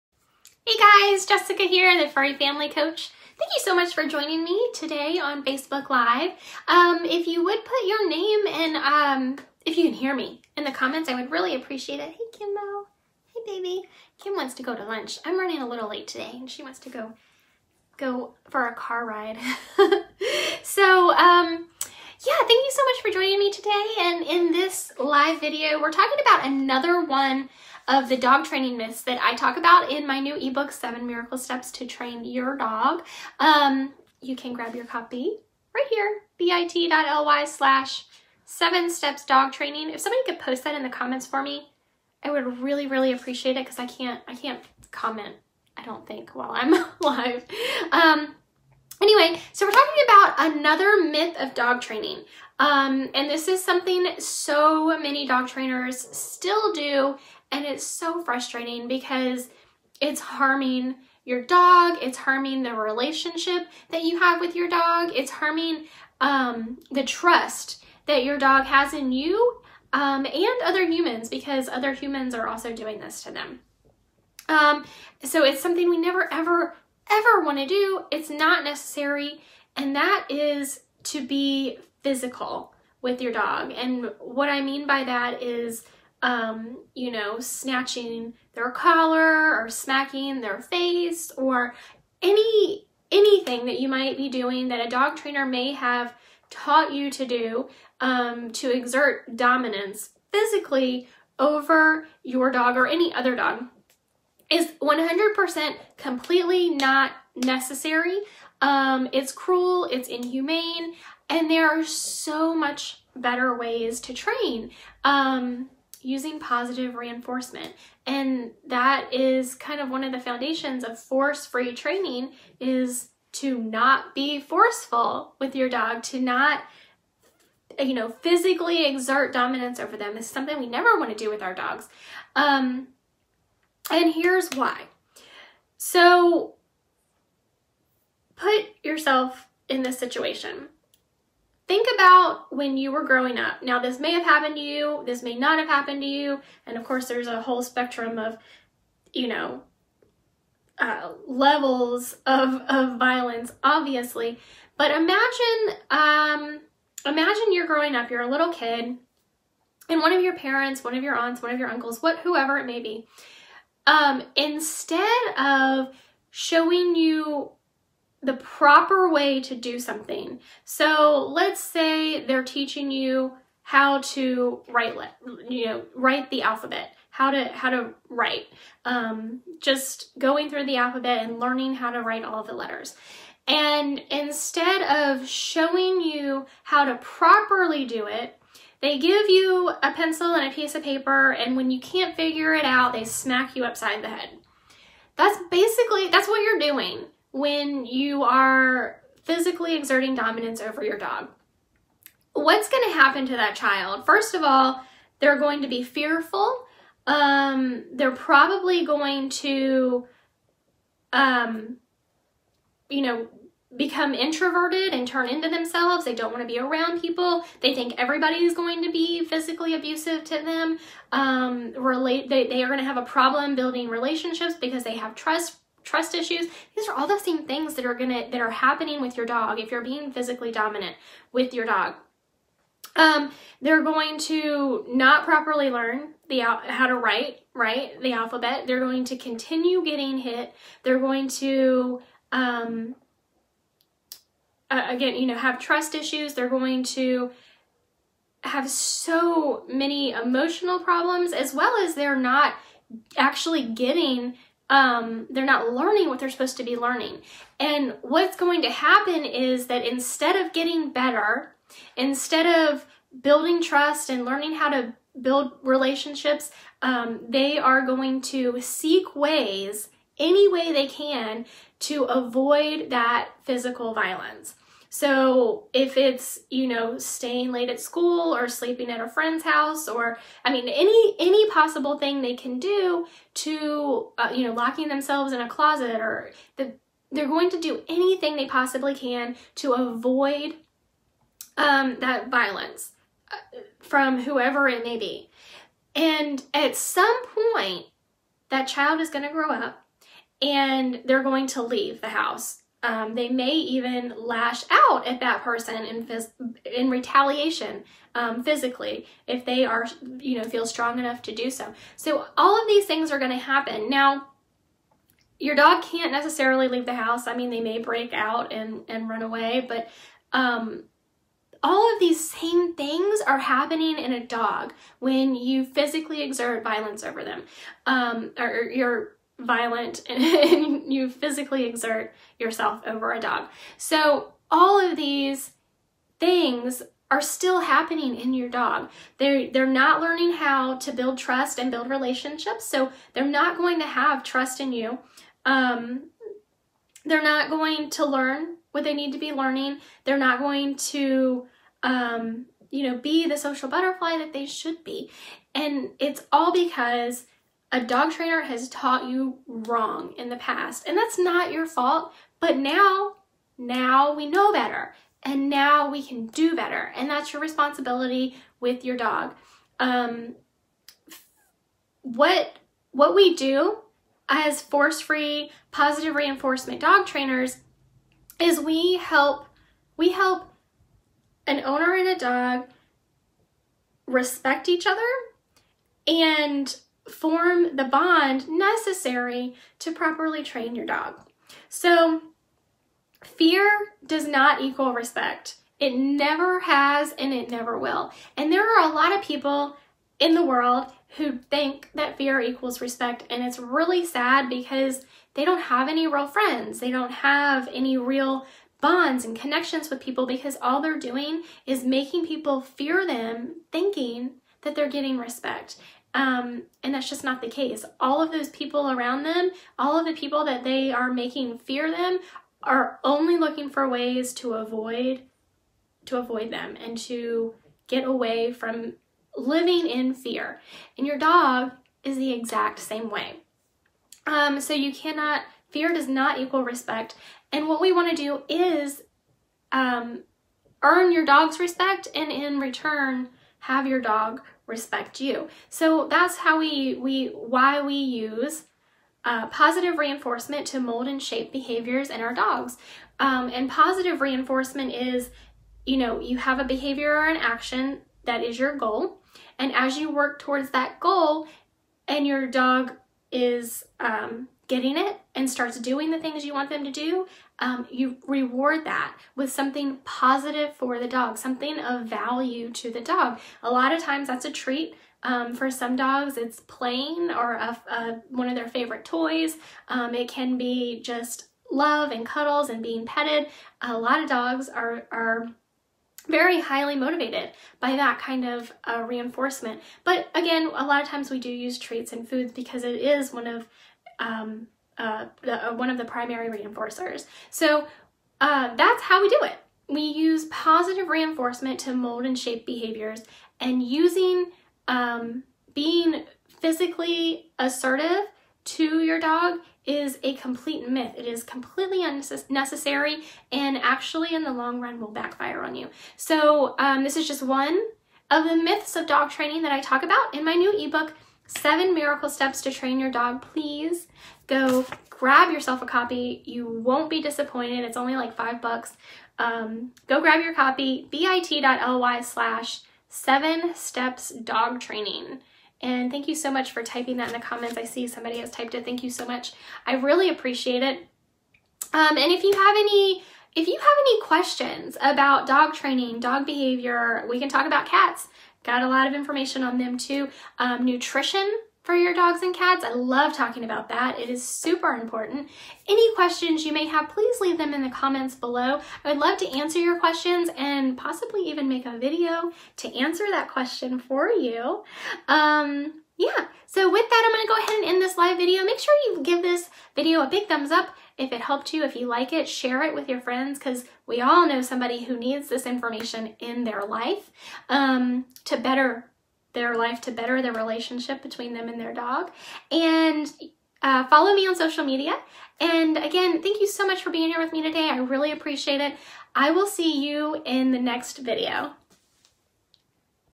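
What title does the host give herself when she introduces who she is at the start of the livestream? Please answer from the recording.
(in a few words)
Furry Family Coach.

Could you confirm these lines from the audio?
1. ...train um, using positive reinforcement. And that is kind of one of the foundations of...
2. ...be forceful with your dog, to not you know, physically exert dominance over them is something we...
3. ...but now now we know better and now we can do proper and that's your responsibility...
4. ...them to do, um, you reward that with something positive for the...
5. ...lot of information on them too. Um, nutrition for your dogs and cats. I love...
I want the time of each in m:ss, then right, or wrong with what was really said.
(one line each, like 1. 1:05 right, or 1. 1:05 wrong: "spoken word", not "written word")
1. 1:54 right
2. 2:04 right
3. 6:02 wrong: "better", not "proper"
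4. 7:46 right
5. 9:08 right.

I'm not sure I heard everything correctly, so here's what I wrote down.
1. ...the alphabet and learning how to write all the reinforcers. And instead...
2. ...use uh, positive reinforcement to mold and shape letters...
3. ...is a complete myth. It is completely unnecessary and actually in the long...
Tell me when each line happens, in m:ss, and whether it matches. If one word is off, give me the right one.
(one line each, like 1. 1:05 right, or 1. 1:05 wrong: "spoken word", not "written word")
1. 3:00 wrong: "letters", not "reinforcers"
2. 7:27 wrong: "behaviors", not "letters"
3. 8:29 right.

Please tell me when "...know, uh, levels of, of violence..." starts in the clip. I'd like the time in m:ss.
2:29.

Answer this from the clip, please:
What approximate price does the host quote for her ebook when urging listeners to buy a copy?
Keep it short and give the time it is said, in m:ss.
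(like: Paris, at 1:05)
$5, at 8:48.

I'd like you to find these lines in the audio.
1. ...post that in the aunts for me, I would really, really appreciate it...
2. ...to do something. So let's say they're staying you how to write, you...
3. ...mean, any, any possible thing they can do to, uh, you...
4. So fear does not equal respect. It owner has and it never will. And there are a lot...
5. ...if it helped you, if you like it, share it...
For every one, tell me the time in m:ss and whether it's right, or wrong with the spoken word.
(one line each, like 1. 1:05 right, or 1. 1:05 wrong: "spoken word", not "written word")
1. 0:40 wrong: "comments", not "aunts"
2. 2:49 wrong: "teaching", not "staying"
3. 4:40 right
4. 6:31 wrong: "never", not "owner"
5. 9:31 right.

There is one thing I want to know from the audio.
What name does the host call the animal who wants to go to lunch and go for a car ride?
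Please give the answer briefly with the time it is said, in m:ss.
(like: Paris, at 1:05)
Kimbo, at 0:12.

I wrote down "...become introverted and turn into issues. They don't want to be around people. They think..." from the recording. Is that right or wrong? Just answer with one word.
wrong.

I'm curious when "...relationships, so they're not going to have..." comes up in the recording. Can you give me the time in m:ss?
5:41.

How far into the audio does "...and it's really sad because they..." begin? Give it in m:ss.
6:43.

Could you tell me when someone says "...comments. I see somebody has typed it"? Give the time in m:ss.
8:57.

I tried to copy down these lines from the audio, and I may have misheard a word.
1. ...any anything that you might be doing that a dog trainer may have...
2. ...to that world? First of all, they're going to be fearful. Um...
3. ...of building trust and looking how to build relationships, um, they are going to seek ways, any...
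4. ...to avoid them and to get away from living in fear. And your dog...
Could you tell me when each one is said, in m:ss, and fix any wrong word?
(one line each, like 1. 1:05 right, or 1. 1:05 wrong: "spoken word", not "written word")
1. 1:32 right
2. 3:23 wrong: "child", not "world"
3. 4:22 wrong: "learning", not "looking"
4. 7:06 right.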